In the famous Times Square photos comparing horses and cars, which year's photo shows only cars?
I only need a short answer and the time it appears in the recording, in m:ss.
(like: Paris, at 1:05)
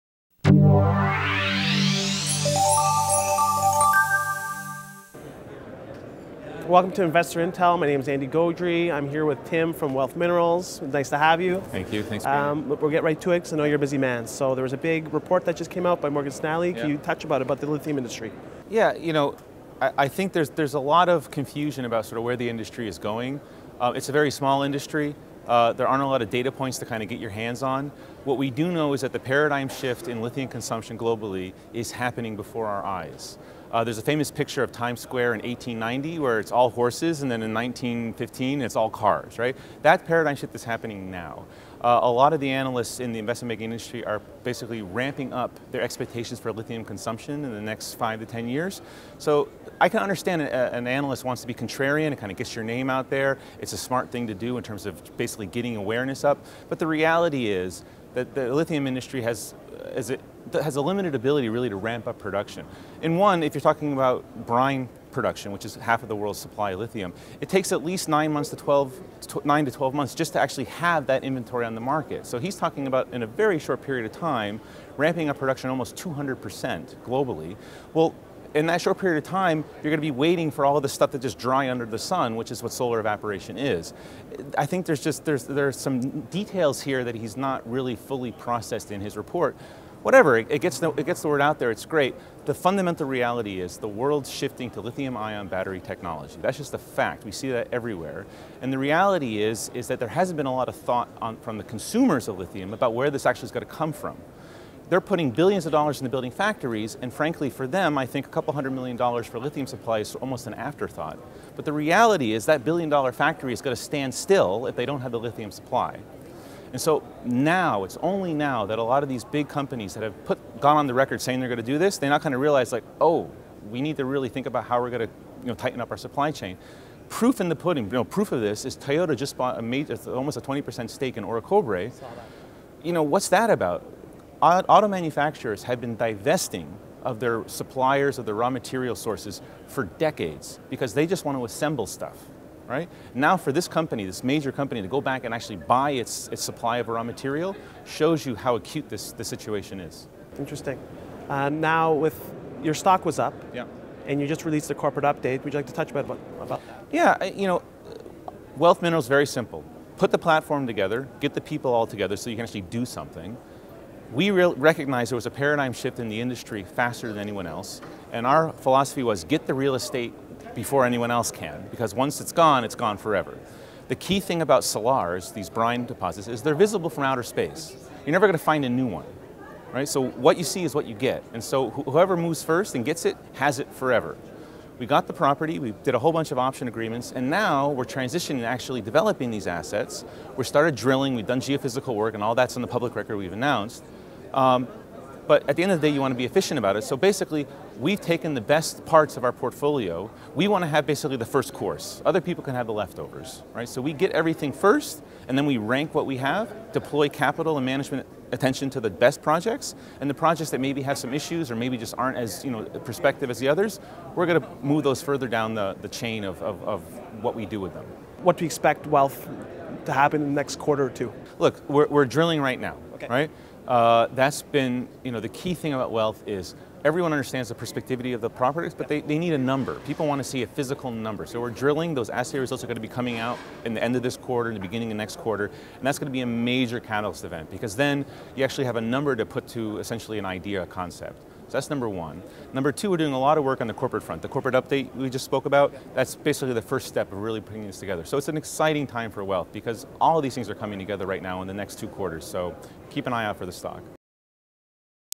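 1915, at 0:37.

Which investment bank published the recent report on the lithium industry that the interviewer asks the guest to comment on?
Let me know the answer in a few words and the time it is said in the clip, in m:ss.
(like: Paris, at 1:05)
Morgan Stanley, at 0:16.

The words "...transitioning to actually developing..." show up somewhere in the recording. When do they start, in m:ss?
3:07.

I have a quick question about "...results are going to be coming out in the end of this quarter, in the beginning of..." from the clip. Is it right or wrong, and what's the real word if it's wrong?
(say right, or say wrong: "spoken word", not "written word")
right.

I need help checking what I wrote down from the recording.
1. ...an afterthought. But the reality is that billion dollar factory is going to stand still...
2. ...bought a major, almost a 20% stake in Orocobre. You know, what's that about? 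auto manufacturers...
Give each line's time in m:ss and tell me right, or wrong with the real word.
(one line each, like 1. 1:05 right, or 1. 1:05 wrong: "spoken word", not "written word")
1. 1:50 right
2. 2:09 right.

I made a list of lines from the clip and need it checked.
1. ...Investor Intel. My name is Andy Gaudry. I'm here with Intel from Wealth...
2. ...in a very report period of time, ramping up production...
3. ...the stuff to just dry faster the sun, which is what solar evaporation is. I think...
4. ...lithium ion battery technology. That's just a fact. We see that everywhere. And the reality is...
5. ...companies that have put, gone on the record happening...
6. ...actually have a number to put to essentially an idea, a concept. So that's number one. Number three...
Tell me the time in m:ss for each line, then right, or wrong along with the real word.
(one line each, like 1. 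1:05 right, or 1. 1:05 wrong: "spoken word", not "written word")
1. 0:07 wrong: "Tim", not "Intel"
2. 1:13 wrong: "short", not "report"
3. 1:20 wrong: "under", not "faster"
4. 1:34 right
5. 1:59 wrong: "saying", not "happening"
6. 3:58 wrong: "two", not "three".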